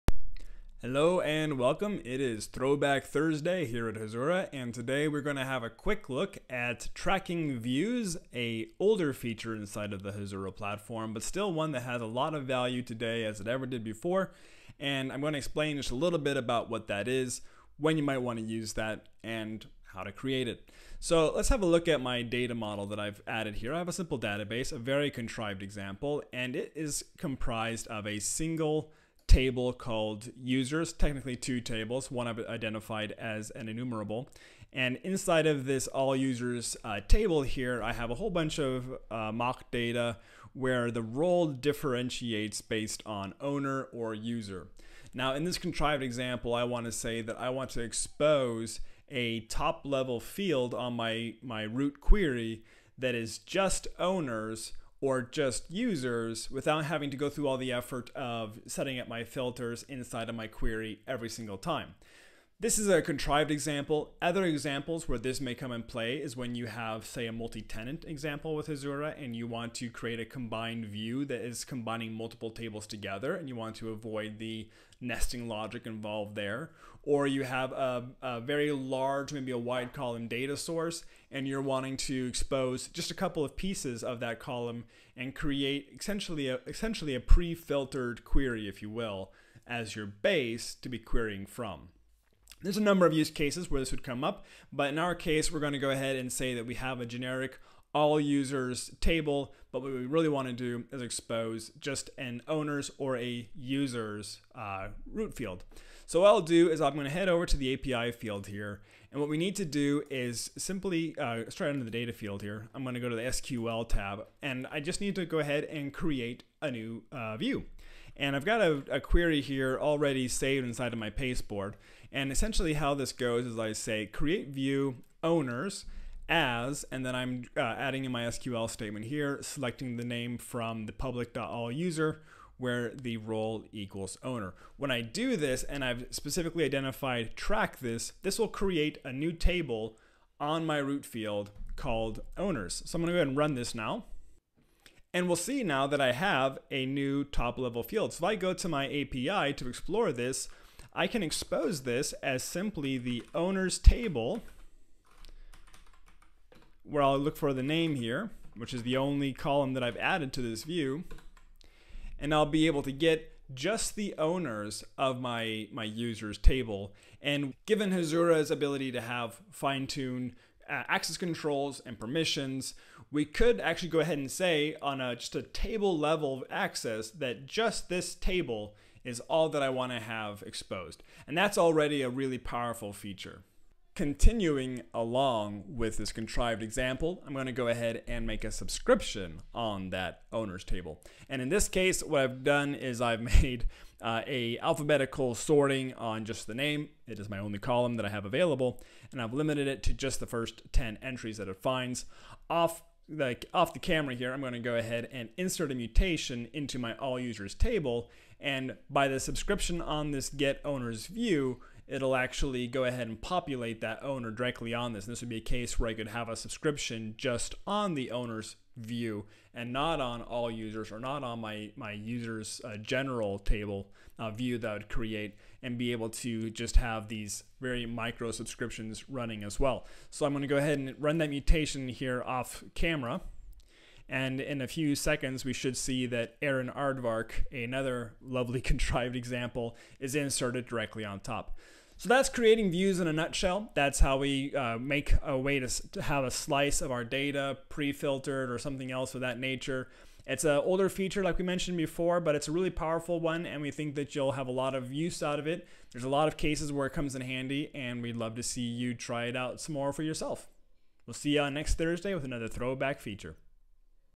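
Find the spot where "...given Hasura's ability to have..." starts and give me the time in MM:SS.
02:47.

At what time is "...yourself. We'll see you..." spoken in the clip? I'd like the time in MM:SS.
04:20.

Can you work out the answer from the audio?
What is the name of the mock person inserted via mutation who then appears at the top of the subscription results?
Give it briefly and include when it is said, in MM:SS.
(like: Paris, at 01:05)
Aaron Aardvark, at 03:56.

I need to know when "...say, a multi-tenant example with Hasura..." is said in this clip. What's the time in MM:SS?
01:07.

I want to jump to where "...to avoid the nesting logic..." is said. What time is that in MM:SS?
01:13.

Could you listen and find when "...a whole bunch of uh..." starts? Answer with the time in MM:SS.
00:38.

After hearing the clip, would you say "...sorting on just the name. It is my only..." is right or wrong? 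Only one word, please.
right.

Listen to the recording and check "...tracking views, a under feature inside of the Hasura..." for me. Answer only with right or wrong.
wrong.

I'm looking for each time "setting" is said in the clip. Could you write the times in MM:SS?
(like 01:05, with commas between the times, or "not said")
00:58.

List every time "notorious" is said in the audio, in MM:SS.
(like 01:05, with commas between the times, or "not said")
not said.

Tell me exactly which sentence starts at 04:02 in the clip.
So that's creating views in a nutshell.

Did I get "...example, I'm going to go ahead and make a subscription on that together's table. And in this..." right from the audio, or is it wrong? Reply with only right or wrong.
wrong.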